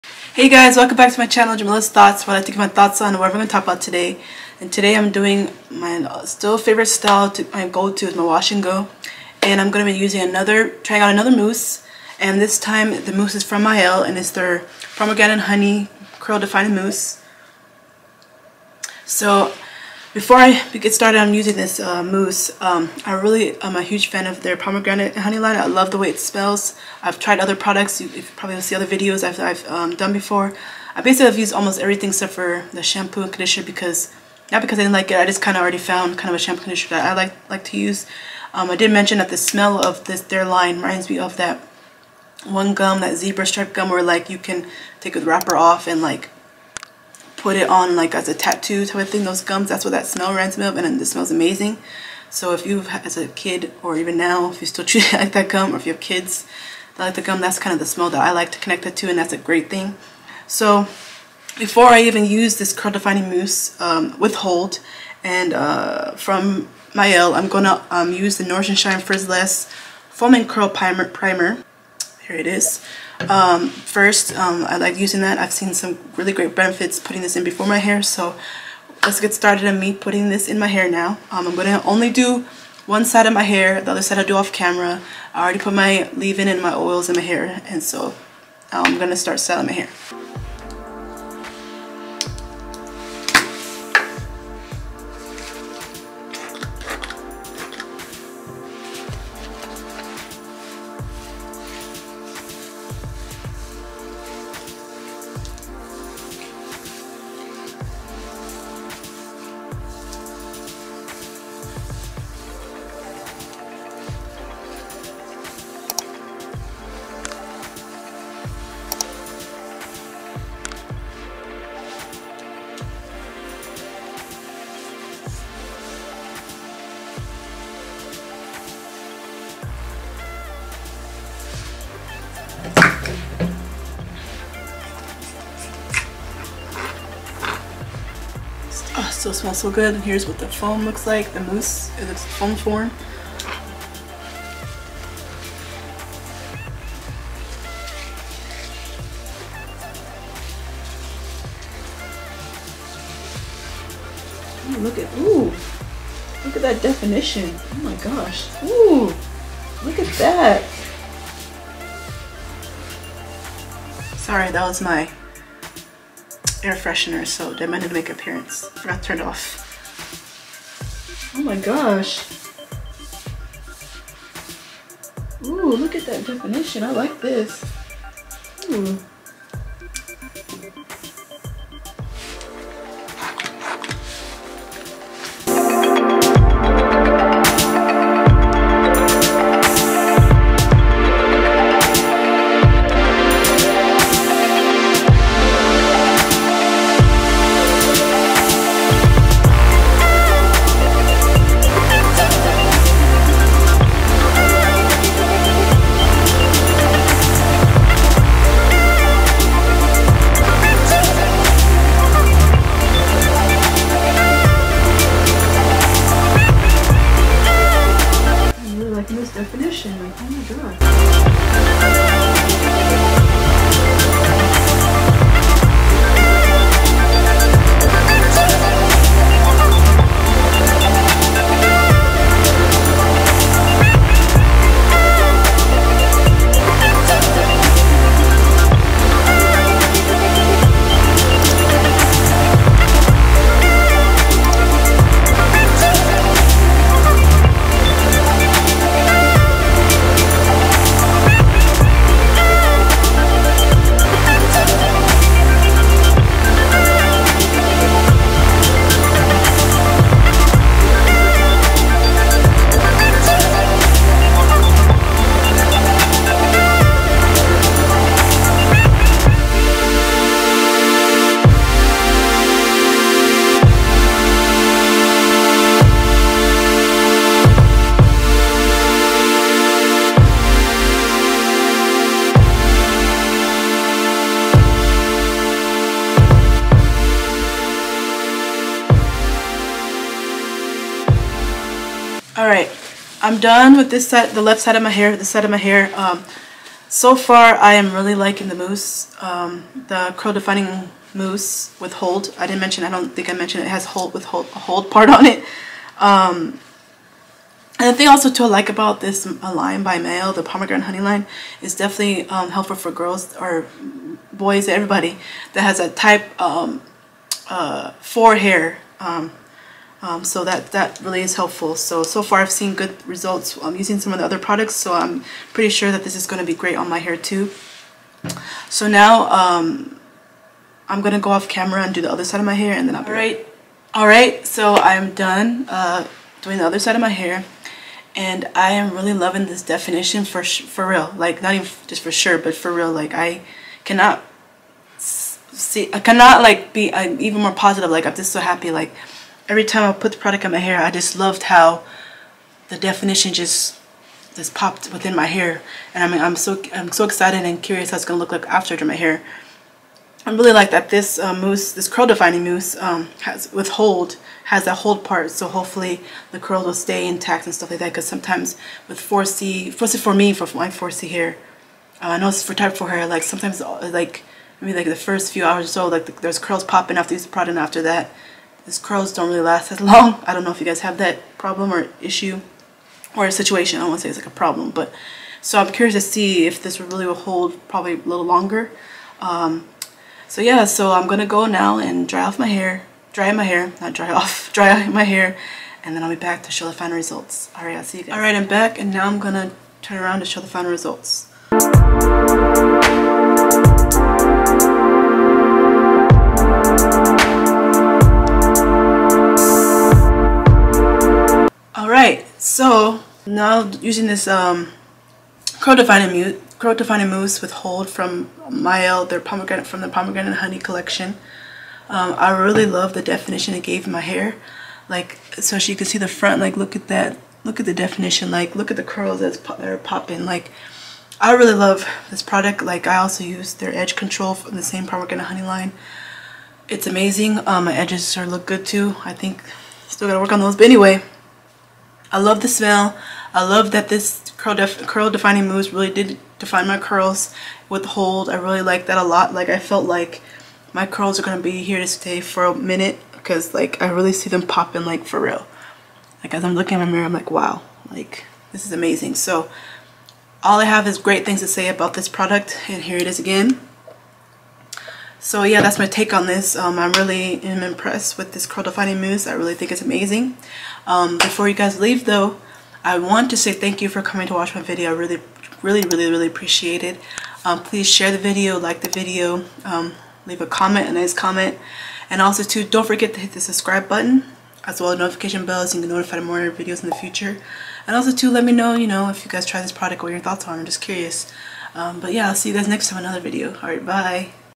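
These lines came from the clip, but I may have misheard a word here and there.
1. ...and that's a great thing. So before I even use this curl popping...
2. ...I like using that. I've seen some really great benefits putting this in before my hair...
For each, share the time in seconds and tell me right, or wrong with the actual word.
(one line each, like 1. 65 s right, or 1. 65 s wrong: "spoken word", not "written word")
1. 59 s wrong: "defining", not "popping"
2. 74 s right.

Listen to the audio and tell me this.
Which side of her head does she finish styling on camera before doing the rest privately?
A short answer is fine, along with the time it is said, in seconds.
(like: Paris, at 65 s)
Left side, at 294 s.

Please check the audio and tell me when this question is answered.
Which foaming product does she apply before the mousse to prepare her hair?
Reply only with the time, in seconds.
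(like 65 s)
68 s.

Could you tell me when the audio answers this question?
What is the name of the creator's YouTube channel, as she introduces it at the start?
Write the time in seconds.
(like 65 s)
1 s.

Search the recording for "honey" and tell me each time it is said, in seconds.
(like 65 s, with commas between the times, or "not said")
15 s, 25 s, 310 s, 420 s, 435 s.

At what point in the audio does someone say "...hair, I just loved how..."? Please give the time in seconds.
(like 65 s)
350 s.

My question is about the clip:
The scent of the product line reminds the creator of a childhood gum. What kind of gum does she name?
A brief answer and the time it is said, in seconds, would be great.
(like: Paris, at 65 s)
Zebra stripe gum, at 43 s.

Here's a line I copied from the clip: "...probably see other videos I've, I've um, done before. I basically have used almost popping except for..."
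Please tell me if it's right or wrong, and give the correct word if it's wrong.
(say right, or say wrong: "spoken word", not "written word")
wrong: "everything", not "popping".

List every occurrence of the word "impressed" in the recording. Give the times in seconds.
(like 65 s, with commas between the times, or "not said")
467 s.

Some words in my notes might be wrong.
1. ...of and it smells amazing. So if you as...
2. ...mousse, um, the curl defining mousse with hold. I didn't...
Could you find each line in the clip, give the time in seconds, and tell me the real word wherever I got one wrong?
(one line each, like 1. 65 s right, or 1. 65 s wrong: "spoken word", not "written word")
1. 50 s right
2. 298 s right.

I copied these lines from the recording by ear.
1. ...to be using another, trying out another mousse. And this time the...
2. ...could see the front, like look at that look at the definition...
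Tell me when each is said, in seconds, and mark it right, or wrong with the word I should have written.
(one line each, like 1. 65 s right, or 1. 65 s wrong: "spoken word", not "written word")
1. 9 s right
2. 425 s right.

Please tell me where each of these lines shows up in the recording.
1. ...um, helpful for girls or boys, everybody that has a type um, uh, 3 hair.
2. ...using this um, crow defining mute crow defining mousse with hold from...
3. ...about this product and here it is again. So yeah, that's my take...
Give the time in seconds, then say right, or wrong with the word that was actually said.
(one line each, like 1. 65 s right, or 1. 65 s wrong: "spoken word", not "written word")
1. 312 s wrong: "4", not "3"
2. 413 s right
3. 461 s right.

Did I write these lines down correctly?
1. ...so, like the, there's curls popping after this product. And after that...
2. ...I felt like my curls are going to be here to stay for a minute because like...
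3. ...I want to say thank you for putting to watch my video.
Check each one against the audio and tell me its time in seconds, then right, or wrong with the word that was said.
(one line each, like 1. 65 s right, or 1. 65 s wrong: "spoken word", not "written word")
1. 375 s right
2. 449 s right
3. 472 s wrong: "coming", not "putting".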